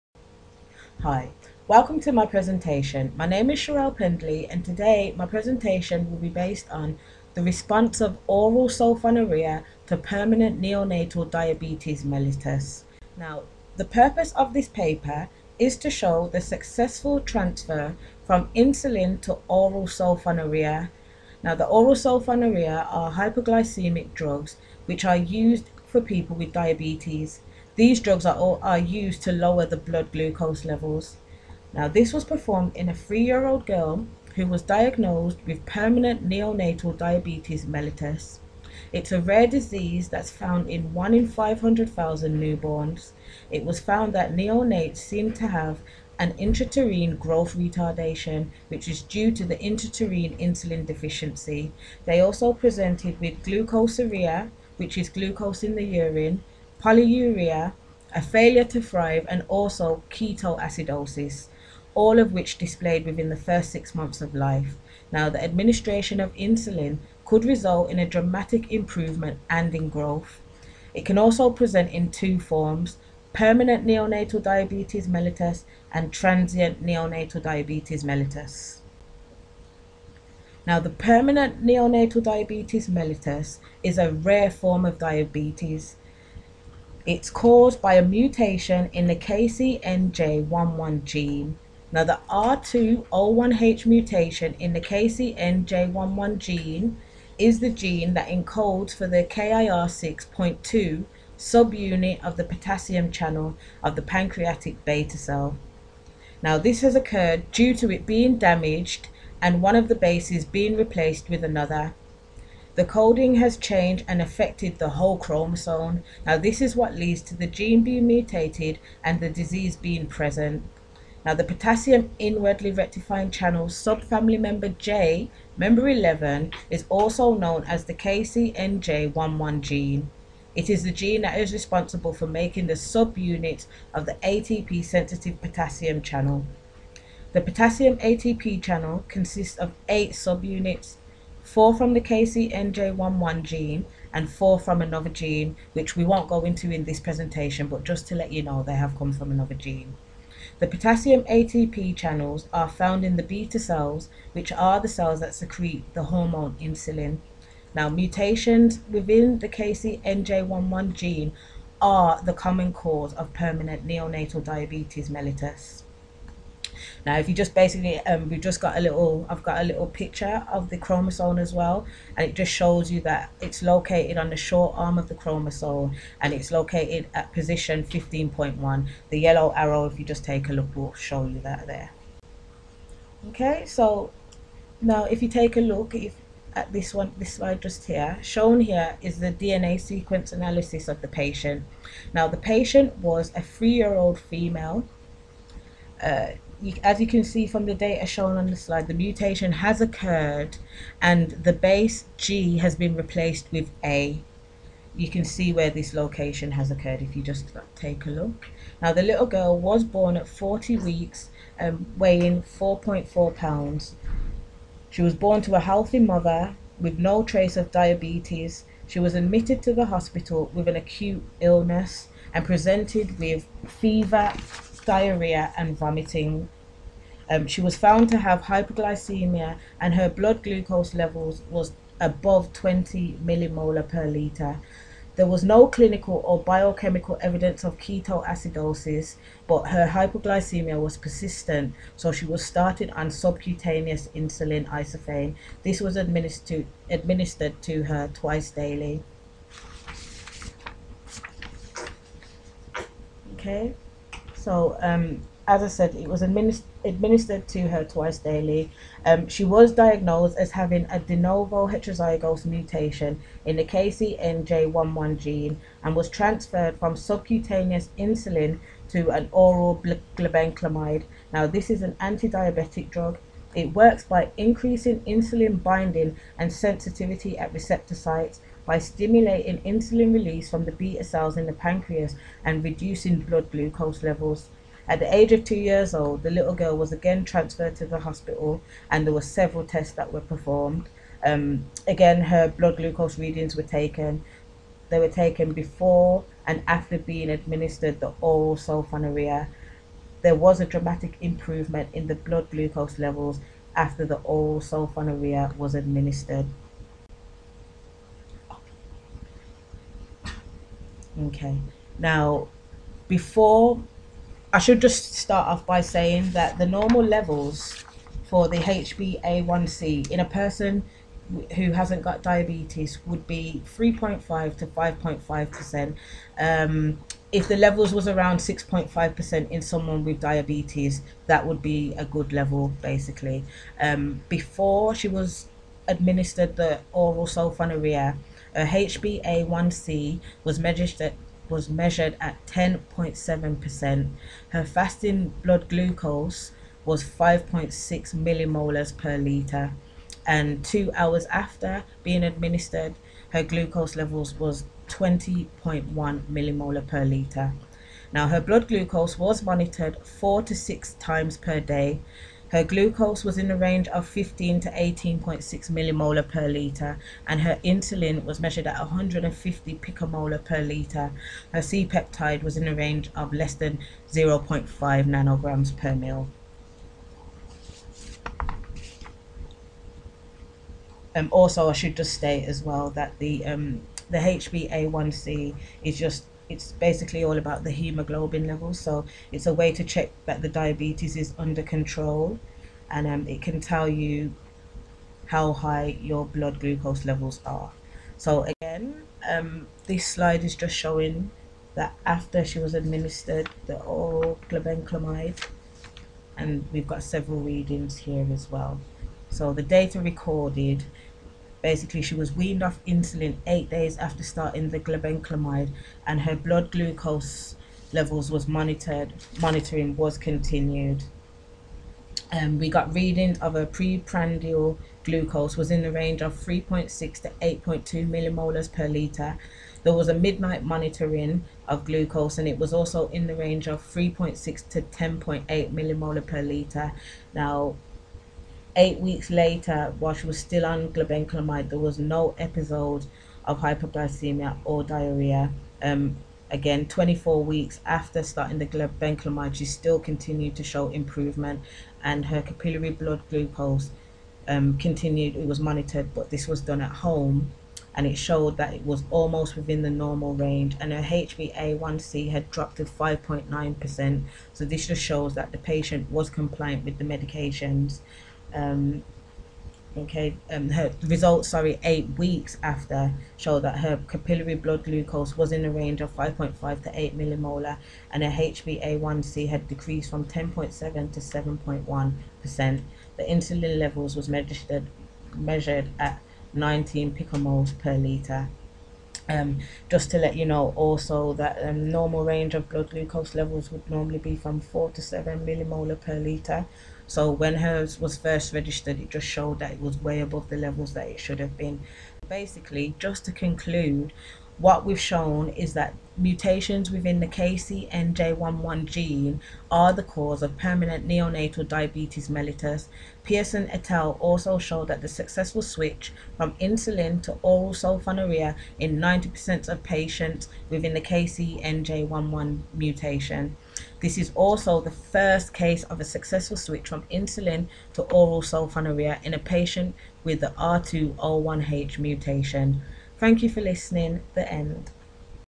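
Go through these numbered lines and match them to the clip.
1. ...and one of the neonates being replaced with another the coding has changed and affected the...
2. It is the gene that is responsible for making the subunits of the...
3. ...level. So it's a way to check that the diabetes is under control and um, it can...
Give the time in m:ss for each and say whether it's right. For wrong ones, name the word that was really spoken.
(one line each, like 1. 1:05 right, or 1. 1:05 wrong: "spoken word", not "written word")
1. 1:49 wrong: "bases", not "neonates"
2. 2:10 right
3. 6:28 right.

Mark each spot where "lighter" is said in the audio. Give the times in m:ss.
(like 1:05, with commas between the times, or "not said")
not said.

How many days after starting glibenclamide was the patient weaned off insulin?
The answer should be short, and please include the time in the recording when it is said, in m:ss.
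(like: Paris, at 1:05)
8, at 6:53.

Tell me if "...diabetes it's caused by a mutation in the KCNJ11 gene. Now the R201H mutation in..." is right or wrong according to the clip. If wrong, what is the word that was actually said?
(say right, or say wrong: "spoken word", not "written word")
right.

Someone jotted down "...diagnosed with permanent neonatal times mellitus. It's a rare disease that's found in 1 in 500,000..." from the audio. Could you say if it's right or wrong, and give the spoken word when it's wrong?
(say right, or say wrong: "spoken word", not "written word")
wrong: "diabetes", not "times".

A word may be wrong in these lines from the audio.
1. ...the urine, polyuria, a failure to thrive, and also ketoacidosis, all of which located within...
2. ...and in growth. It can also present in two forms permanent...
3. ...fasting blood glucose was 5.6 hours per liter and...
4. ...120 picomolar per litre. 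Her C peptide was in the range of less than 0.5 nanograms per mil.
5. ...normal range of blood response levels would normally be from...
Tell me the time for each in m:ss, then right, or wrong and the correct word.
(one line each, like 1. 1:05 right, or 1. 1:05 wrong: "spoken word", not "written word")
1. 0:55 wrong: "displayed", not "located"
2. 1:09 right
3. 5:44 wrong: "millimolars", not "hours"
4. 6:08 wrong: "150", not "120"
5. 8:11 wrong: "glucose", not "response".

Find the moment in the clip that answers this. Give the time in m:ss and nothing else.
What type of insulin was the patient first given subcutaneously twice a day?
4:04.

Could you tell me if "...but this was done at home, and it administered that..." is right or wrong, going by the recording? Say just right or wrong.
wrong.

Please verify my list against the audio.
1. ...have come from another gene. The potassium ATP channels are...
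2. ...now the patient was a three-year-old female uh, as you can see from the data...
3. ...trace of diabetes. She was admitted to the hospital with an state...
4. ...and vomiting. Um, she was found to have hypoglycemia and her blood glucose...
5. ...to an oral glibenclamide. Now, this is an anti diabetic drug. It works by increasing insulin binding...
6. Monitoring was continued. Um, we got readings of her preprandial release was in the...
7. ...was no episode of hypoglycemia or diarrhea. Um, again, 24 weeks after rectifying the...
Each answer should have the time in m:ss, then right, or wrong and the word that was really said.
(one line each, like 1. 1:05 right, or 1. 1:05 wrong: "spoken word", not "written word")
1. 2:28 right
2. 3:12 right
3. 3:37 wrong: "acute", not "state"
4. 3:45 right
5. 4:28 right
6. 6:59 wrong: "glucose", not "release"
7. 7:21 wrong: "starting", not "rectifying".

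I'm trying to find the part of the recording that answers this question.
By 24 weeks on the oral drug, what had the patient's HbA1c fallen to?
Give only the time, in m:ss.
7:42.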